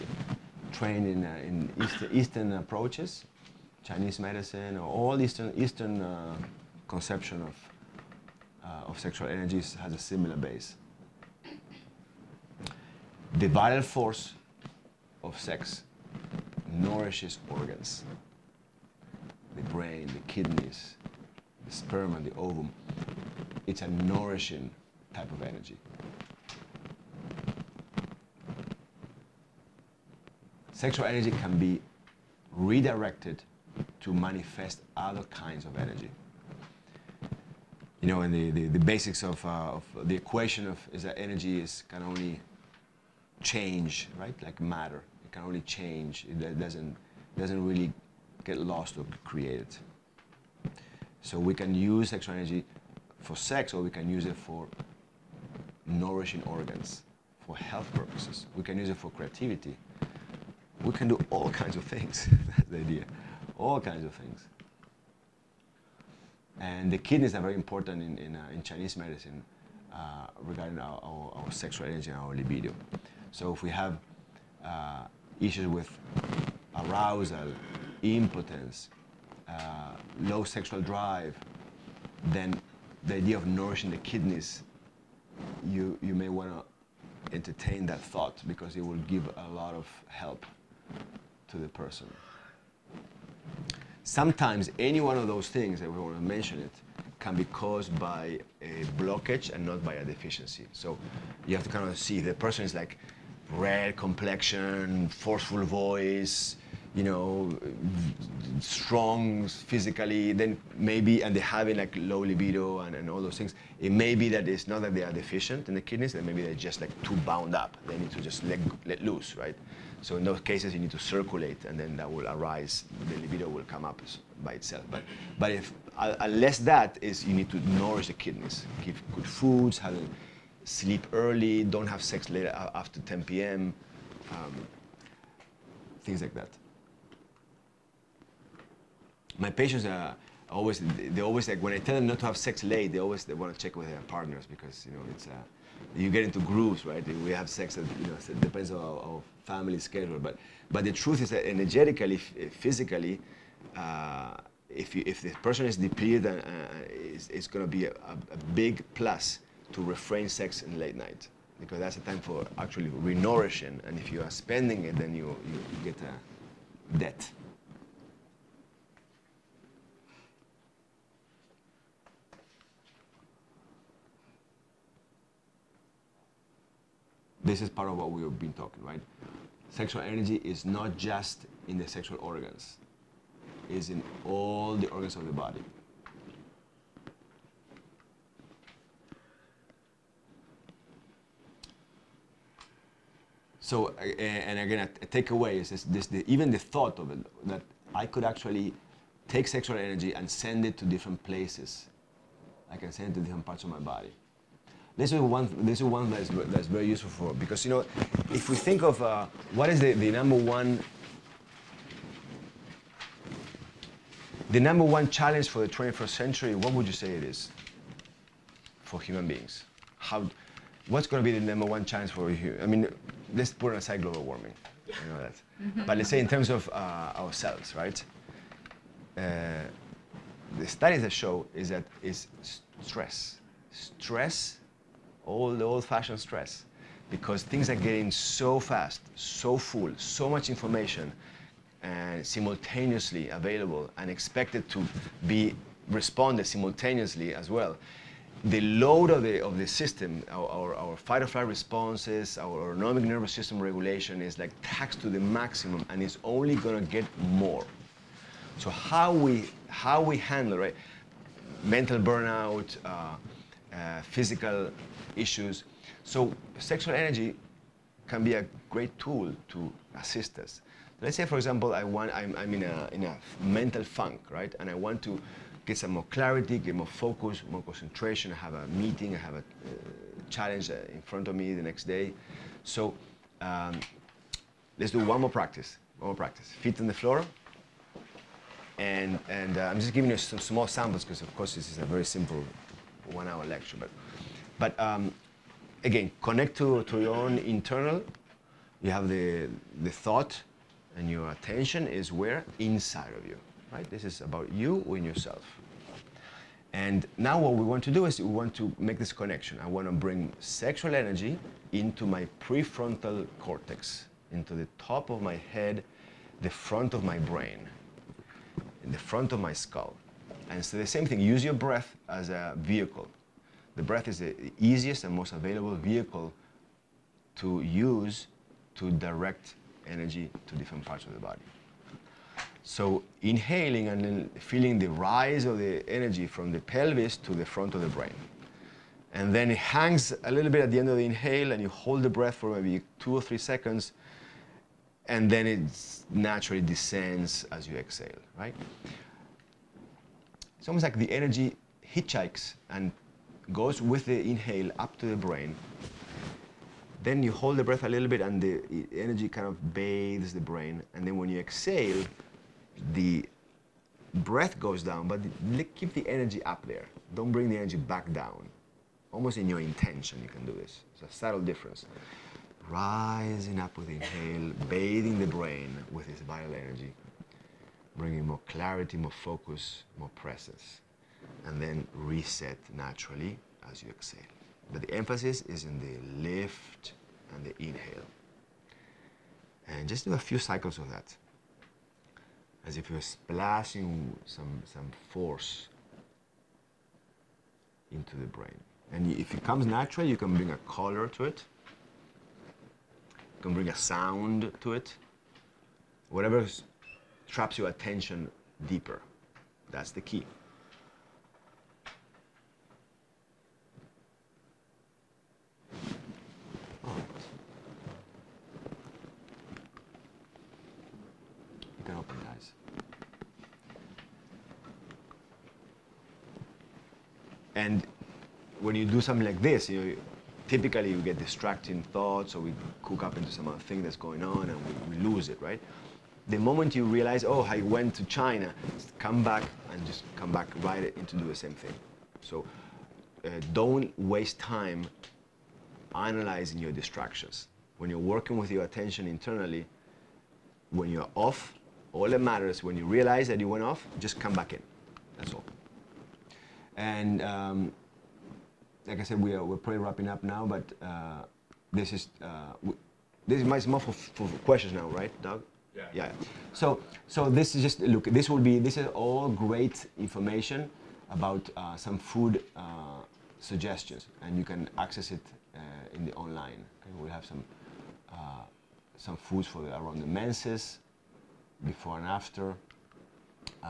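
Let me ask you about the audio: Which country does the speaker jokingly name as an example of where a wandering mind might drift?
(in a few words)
China.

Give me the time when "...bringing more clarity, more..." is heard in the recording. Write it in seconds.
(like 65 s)
377 s.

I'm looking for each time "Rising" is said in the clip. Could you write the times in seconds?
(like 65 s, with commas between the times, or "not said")
372 s.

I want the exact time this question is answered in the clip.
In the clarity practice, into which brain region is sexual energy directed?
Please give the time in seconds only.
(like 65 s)
312 s.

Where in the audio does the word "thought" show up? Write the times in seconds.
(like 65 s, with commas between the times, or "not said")
87 s, 196 s, 299 s, 431 s.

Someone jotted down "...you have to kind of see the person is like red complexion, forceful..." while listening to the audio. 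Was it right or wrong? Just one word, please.
right.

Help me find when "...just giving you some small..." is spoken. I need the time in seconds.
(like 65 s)
289 s.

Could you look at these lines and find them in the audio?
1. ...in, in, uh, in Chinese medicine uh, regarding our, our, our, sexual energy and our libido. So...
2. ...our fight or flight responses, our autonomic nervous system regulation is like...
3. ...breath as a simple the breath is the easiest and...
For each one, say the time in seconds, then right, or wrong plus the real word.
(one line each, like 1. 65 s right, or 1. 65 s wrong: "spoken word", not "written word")
1. 68 s right
2. 250 s right
3. 321 s wrong: "vehicle", not "simple".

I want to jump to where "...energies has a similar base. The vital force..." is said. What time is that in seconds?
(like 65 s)
9 s.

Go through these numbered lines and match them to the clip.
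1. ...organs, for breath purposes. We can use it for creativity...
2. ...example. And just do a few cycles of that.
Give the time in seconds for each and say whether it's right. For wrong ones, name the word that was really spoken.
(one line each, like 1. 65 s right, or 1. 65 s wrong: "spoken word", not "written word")
1. 56 s wrong: "health", not "breath"
2. 387 s wrong: "inhale", not "example".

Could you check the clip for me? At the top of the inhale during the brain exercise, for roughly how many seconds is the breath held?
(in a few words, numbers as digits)
2 or 3.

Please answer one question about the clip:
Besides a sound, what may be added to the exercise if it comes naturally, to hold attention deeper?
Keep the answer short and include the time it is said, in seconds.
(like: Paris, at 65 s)
A color, at 400 s.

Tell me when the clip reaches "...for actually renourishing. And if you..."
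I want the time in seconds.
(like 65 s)
162 s.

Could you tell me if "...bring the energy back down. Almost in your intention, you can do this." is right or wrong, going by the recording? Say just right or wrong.
right.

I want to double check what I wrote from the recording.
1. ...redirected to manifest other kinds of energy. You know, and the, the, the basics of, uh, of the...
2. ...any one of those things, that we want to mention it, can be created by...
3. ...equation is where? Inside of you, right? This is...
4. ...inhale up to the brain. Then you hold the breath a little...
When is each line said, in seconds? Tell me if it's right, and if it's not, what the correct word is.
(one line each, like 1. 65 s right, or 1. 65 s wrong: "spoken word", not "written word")
1. 32 s right
2. 94 s wrong: "caused", not "created"
3. 301 s wrong: "attention", not "equation"
4. 354 s right.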